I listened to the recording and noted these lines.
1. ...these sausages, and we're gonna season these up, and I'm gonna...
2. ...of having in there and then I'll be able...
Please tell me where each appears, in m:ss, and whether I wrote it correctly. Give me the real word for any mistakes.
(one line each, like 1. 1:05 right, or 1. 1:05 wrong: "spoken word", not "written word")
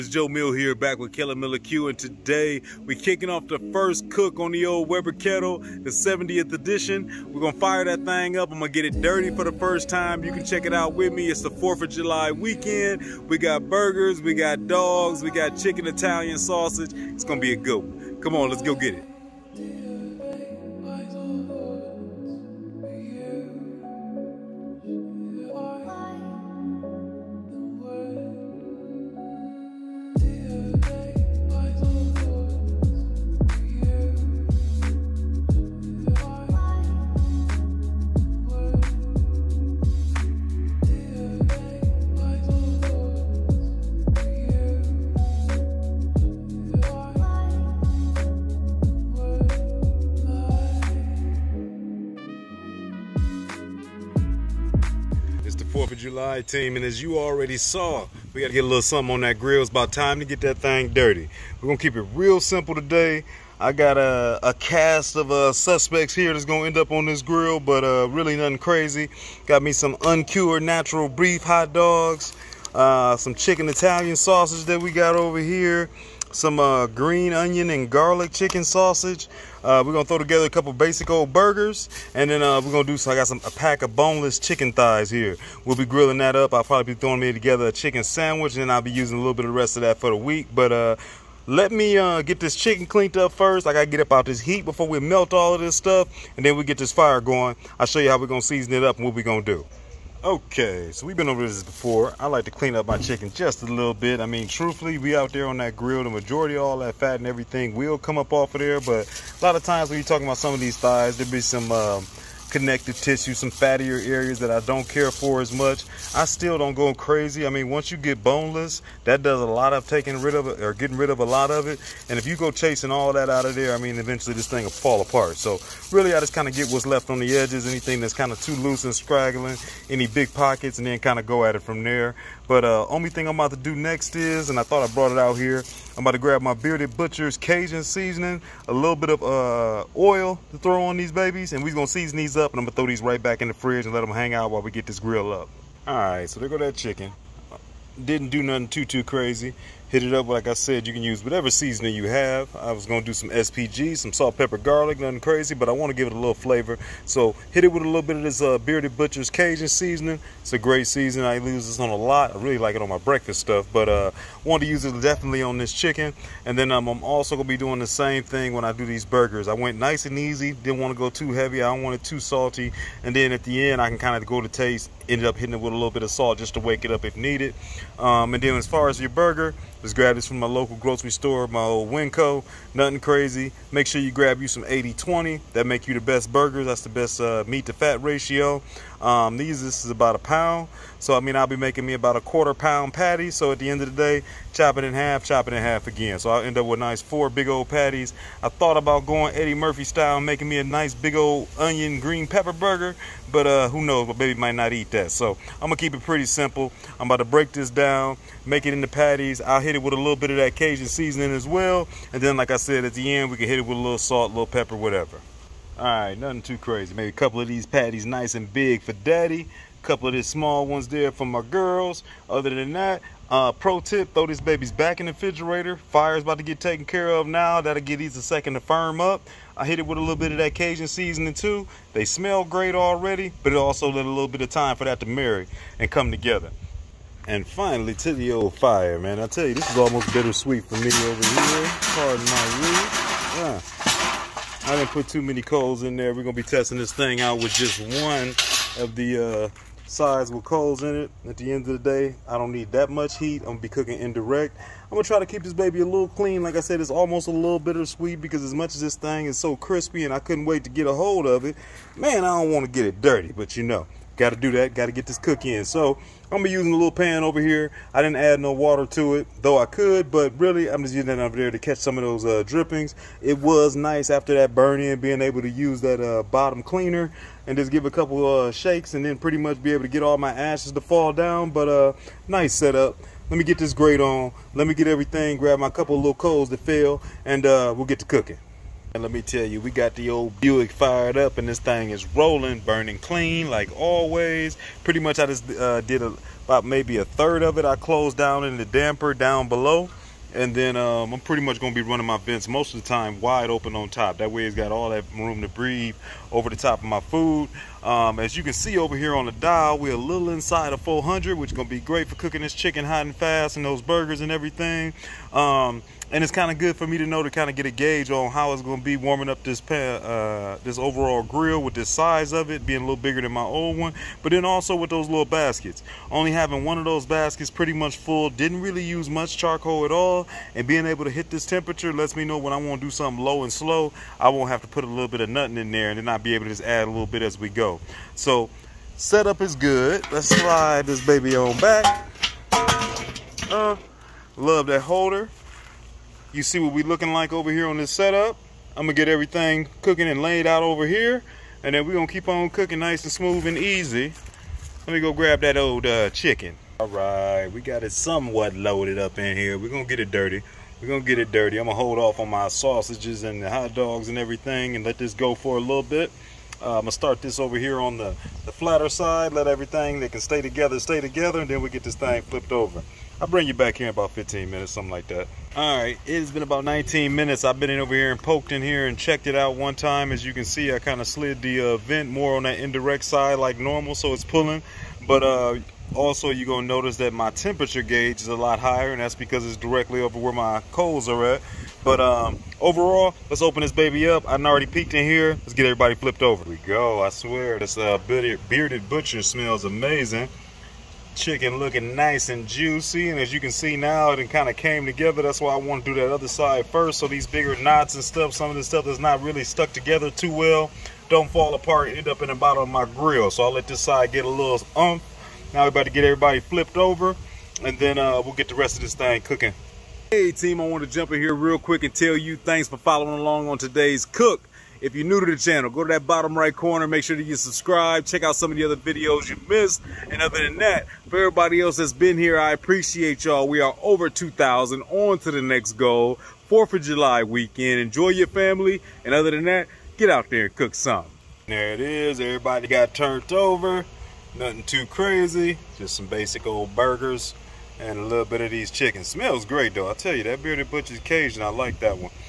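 1. 2:20 wrong: "babies", not "sausages"
2. 5:35 wrong: "nothing", not "having".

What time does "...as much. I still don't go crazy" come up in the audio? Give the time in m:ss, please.
1:55.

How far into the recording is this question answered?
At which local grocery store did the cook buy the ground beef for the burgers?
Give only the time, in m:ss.
3:01.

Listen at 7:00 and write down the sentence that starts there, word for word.
Hey team, I want to jump in here real quick and tell you thanks for following along on today's cook.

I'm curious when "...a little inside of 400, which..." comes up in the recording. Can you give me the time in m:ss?
5:09.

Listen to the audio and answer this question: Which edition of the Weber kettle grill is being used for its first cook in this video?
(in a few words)
70th edition.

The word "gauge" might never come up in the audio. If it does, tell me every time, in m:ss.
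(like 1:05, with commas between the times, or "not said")
5:17, 6:27.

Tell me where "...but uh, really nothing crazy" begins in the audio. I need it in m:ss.
1:07.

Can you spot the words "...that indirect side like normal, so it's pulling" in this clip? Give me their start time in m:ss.
6:22.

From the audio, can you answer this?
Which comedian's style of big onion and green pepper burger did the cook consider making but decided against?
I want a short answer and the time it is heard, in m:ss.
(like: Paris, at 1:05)
Eddie Murphy, at 3:19.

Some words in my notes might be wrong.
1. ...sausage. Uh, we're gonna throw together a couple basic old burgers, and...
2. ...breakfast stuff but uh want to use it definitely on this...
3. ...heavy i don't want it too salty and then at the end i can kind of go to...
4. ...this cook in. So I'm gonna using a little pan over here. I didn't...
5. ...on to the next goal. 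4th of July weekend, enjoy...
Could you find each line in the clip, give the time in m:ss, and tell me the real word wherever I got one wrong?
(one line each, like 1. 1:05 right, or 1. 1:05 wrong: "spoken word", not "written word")
1. 1:18 right
2. 2:42 right
3. 2:51 right
4. 4:25 right
5. 7:14 right.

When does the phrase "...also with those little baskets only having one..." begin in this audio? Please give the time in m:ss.
5:24.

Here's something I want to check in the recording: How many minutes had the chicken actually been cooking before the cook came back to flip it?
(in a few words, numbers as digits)
19.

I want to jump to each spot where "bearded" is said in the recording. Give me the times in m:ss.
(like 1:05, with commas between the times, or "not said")
2:16, 2:38, 6:38, 7:30.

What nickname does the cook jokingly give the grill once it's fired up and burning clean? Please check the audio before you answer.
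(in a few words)
the old Buick.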